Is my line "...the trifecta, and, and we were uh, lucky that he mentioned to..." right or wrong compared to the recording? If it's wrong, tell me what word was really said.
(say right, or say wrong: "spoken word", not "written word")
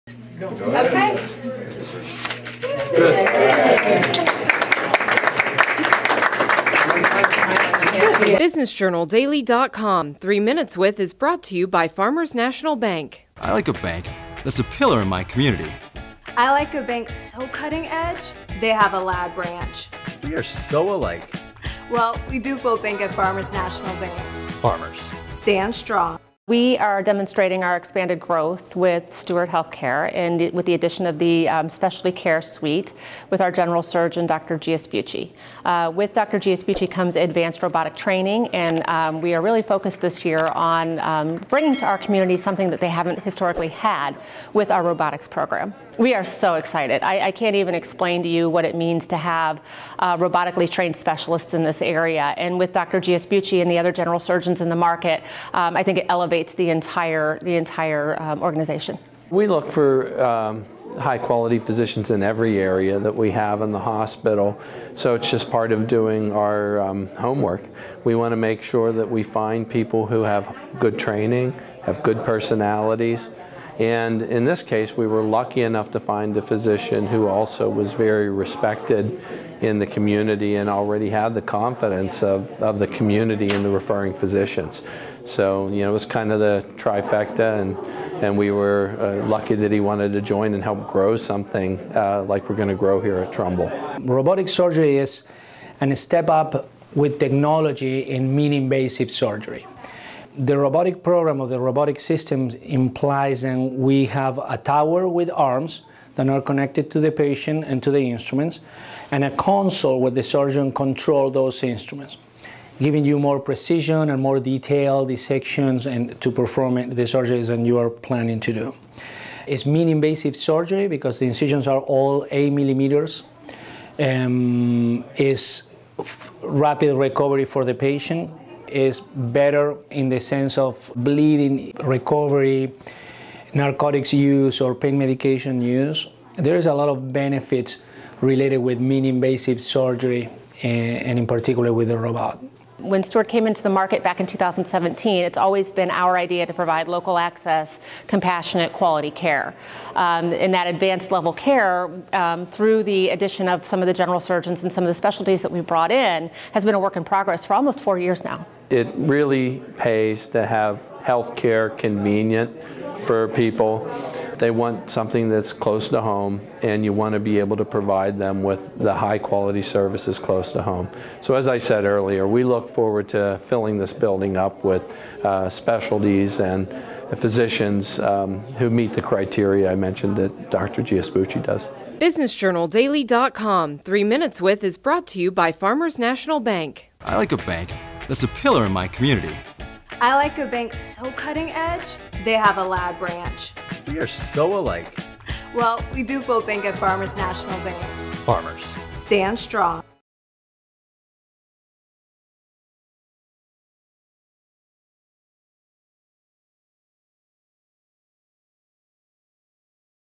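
wrong: "wanted", not "mentioned".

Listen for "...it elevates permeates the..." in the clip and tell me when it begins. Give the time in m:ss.
0:55.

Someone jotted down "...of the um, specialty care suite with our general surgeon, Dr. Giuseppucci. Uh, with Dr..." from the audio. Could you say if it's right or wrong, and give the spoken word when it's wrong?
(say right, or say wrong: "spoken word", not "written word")
right.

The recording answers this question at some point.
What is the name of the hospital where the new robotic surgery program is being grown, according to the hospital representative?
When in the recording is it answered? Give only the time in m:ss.
1:33.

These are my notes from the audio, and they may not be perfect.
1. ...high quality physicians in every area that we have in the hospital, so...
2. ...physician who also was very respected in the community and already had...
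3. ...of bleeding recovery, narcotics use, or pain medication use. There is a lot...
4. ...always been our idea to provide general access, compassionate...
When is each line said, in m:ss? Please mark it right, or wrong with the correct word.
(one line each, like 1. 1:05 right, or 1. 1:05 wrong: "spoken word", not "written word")
1. 1:00 right
2. 1:16 right
3. 2:10 right
4. 2:25 wrong: "local", not "general".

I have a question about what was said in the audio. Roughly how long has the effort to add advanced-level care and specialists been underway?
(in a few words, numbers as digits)
almost four years.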